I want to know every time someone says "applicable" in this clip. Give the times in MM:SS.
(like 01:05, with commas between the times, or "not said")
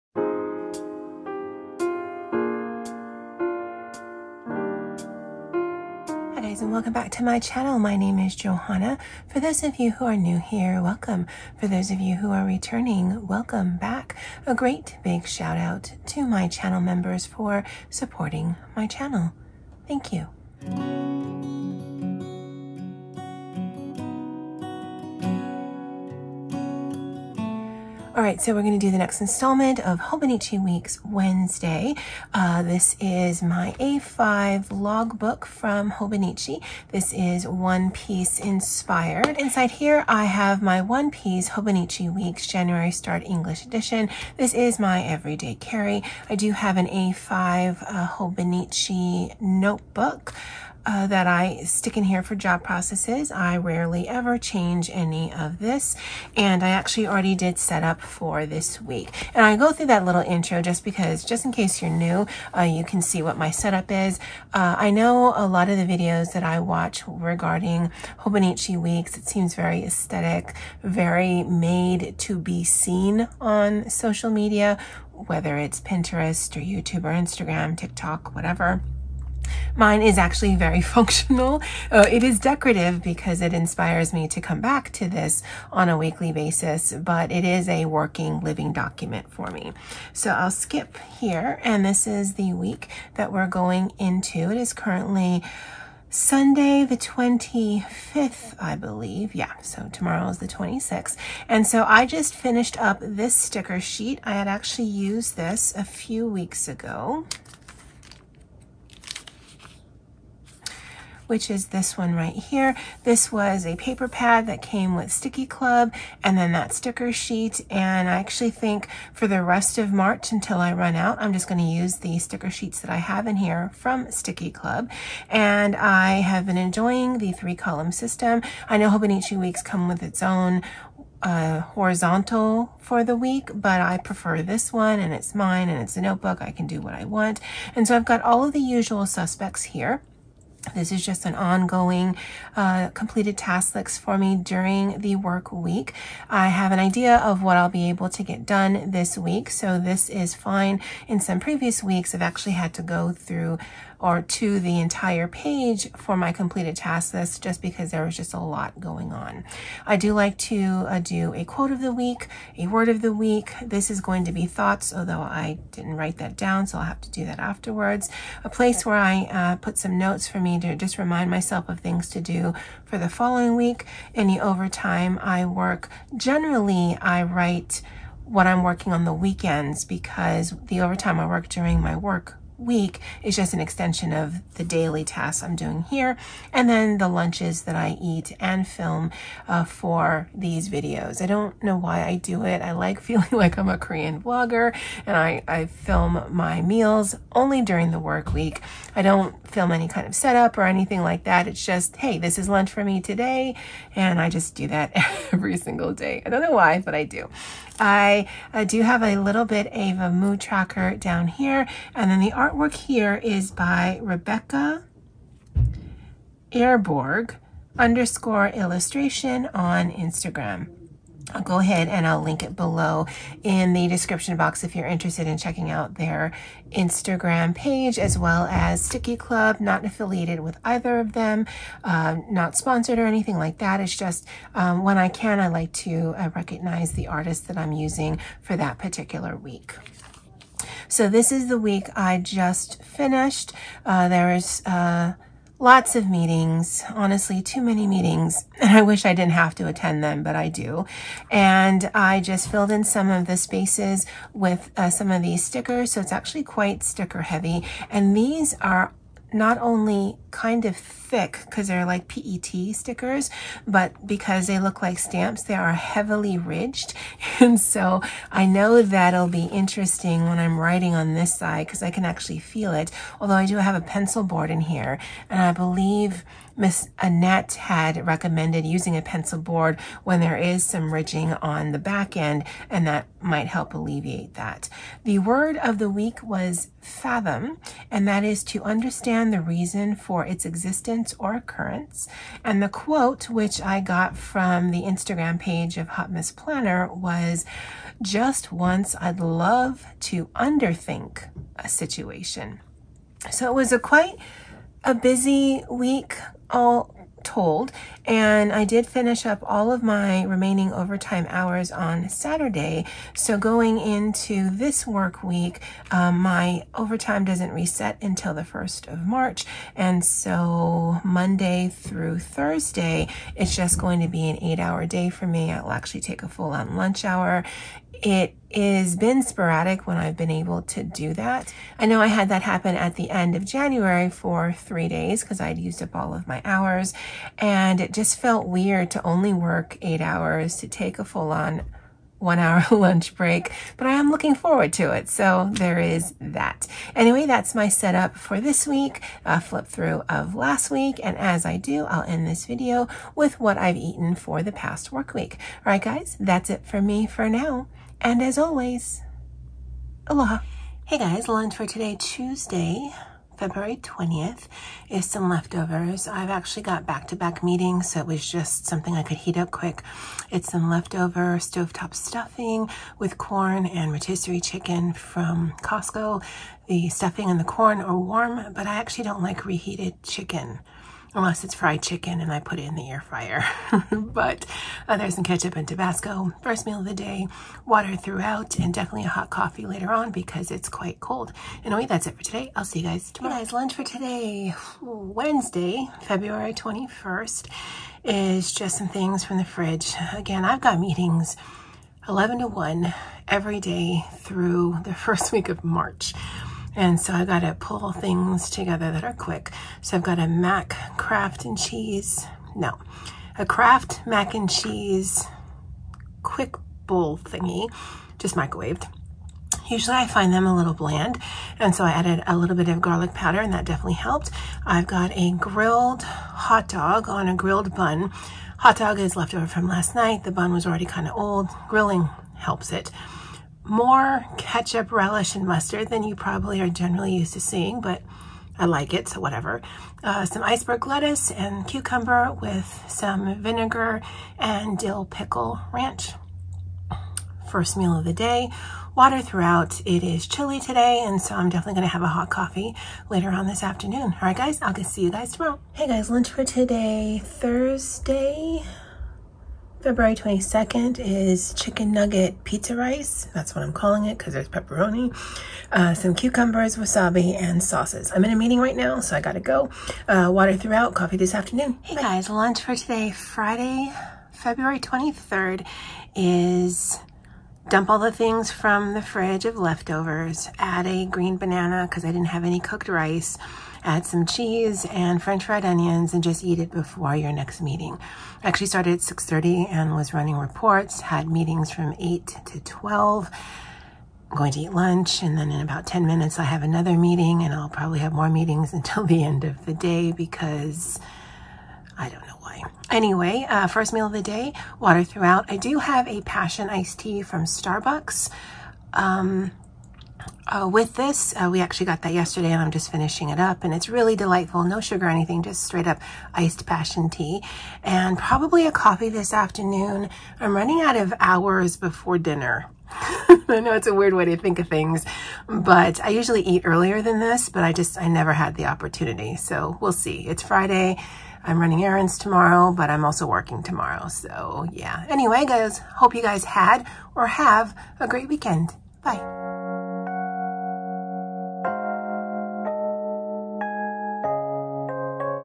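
not said.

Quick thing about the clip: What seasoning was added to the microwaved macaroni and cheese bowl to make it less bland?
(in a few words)
garlic powder.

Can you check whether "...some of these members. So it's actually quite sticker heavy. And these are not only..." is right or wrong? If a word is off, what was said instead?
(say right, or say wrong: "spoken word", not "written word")
wrong: "stickers", not "members".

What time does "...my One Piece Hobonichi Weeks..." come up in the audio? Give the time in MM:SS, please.
00:40.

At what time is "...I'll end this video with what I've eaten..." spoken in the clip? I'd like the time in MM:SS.
05:51.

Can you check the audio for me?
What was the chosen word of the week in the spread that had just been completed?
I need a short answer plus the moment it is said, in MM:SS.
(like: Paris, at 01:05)
fathom, at 04:46.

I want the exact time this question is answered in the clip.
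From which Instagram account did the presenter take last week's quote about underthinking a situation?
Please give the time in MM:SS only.
04:55.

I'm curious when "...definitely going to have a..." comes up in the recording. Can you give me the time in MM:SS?
07:31.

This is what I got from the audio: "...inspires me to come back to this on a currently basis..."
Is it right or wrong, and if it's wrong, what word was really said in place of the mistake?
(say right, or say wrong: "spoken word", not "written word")
wrong: "weekly", not "currently".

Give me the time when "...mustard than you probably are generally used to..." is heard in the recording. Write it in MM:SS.
07:15.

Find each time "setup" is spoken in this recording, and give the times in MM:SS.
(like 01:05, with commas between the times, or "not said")
01:03, 03:20, 05:47.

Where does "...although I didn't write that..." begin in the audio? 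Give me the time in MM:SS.
02:44.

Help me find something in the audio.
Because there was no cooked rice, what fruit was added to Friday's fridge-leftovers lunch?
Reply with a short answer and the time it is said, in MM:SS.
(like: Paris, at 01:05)
green banana, at 08:01.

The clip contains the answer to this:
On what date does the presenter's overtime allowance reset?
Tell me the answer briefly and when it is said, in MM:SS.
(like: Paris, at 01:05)
March 1st, at 05:18.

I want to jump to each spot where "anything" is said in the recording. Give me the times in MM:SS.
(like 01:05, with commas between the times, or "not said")
03:20, 03:53, 08:35.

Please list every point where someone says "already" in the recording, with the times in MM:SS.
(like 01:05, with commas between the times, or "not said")
00:57, 07:10.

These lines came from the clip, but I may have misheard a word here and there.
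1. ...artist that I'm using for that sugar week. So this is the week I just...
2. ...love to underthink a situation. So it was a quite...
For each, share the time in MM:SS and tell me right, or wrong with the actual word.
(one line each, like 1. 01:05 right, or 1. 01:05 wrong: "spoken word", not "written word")
1. 03:57 wrong: "particular", not "sugar"
2. 04:59 right.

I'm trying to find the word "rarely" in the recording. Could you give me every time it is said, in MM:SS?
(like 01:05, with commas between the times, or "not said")
00:53.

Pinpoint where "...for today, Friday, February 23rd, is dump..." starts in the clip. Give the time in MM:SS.
07:52.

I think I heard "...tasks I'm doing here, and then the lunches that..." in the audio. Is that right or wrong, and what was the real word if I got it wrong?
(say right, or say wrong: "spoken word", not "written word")
right.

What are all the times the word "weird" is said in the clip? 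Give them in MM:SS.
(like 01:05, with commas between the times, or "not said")
05:38, 08:43.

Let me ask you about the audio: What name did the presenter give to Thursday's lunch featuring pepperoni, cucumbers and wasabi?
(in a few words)
chicken nugget pizza rice.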